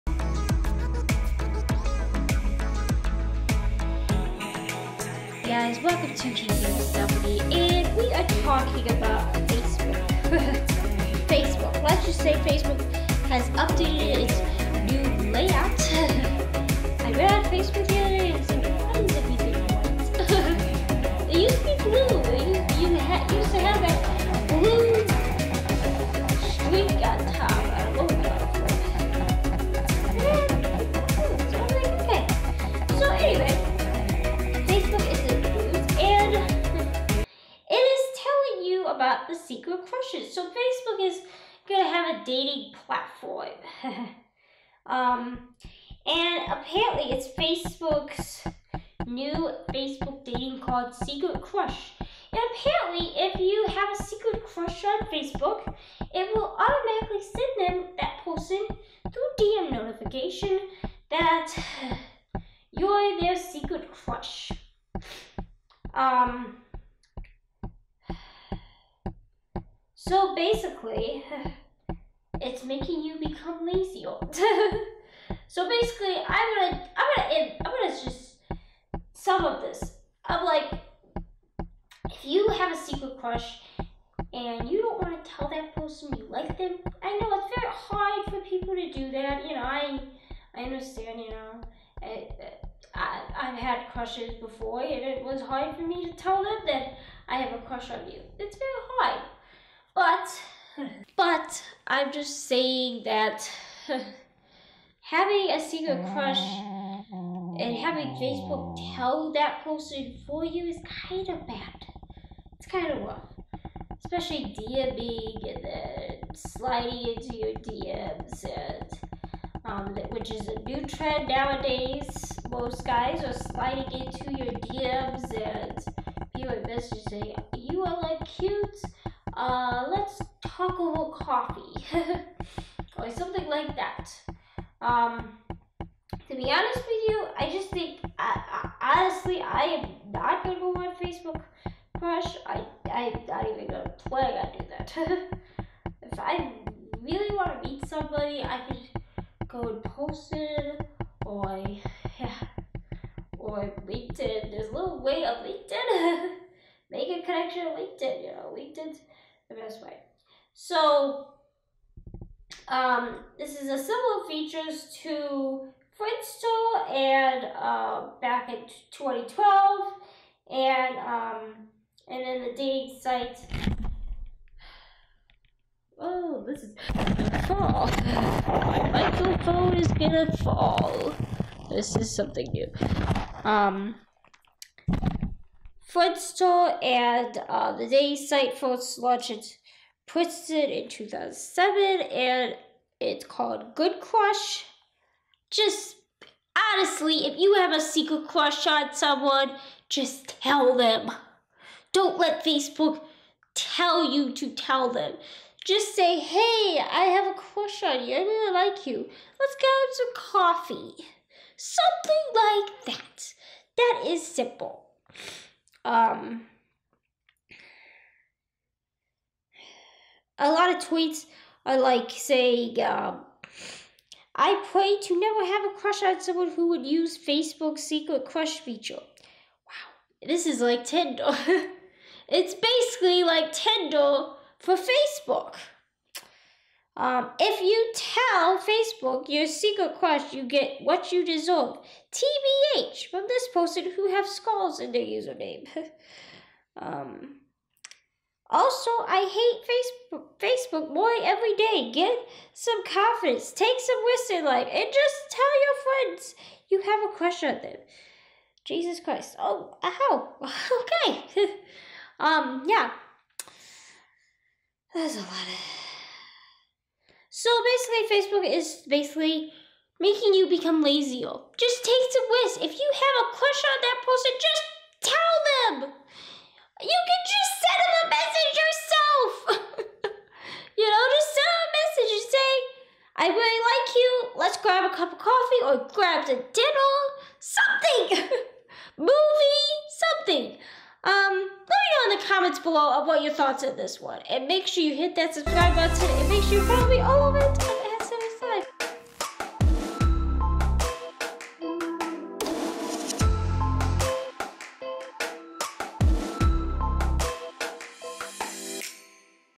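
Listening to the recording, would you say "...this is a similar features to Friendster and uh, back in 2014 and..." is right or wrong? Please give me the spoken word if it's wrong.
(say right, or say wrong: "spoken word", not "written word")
wrong: "2012", not "2014".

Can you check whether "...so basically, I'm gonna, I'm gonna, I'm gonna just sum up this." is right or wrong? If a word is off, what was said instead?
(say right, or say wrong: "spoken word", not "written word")
right.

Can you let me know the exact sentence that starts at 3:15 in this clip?
Just honestly, if you have a secret crush on someone, just tell them.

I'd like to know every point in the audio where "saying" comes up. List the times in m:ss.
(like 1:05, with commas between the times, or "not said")
1:42, 3:42.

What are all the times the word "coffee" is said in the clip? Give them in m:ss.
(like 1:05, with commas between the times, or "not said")
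2:11, 3:30, 4:45.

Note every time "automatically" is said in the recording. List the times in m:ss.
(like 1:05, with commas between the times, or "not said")
0:56.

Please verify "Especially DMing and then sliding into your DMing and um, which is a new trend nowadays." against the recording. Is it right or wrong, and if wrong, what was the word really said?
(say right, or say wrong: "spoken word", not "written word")
wrong: "DMs", not "DMing".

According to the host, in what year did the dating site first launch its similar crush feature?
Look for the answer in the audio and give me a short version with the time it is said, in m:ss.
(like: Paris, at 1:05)
2007, at 3:10.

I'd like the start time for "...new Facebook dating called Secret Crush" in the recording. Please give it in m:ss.
0:49.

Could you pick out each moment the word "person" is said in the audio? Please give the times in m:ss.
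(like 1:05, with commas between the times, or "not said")
0:58, 1:25, 1:49, 4:03, 4:34.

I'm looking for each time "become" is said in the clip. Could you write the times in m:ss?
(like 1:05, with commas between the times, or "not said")
1:13, 4:30.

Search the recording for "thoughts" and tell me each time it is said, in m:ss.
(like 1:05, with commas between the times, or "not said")
4:53.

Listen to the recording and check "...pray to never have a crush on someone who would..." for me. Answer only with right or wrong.
right.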